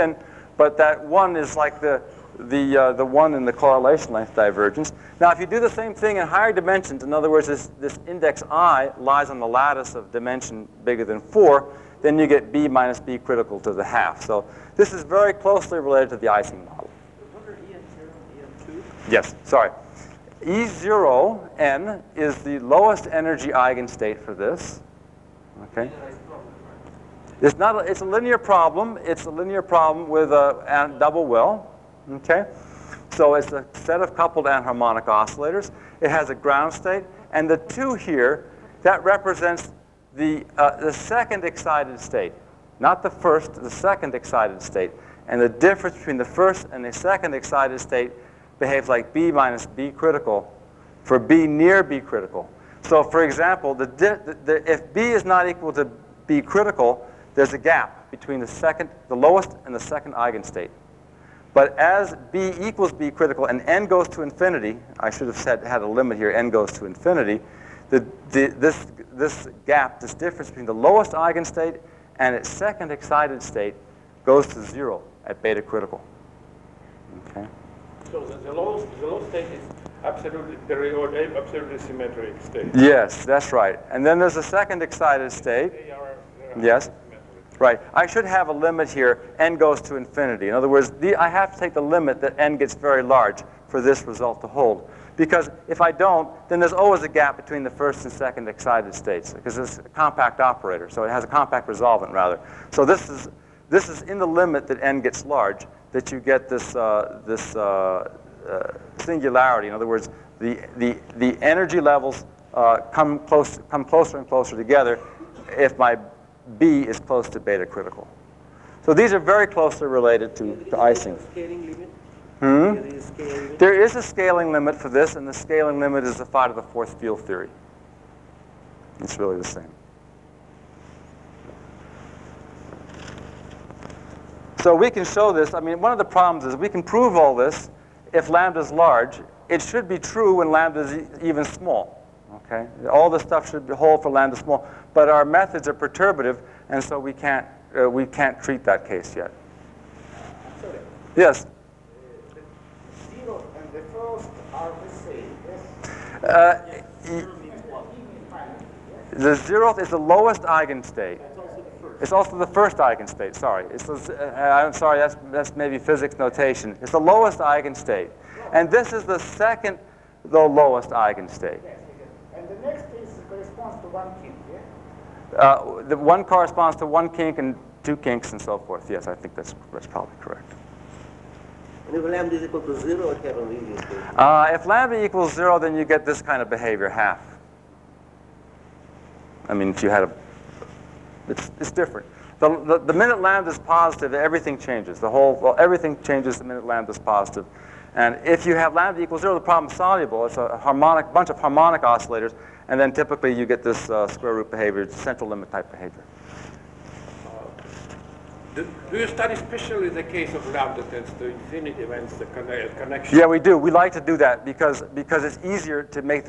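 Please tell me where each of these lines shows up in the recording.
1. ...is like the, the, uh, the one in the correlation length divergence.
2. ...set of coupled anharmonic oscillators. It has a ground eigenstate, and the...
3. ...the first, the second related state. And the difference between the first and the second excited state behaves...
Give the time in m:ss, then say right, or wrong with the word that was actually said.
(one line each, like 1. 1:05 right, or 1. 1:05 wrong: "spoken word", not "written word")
1. 0:01 right
2. 0:33 wrong: "state", not "eigenstate"
3. 0:43 wrong: "excited", not "related".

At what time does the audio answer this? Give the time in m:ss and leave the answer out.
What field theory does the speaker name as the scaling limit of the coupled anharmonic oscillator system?
2:06.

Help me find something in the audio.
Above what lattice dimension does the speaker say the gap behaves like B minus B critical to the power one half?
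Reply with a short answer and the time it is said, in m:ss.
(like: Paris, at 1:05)
4, at 0:10.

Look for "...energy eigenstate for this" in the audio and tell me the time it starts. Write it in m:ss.
0:23.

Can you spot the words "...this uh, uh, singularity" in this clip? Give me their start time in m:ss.
1:47.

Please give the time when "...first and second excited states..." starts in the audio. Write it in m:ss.
1:37.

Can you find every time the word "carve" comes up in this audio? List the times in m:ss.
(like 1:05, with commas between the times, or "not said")
not said.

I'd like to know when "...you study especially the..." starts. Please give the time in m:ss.
3:28.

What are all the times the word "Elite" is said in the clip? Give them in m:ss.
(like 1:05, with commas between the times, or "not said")
not said.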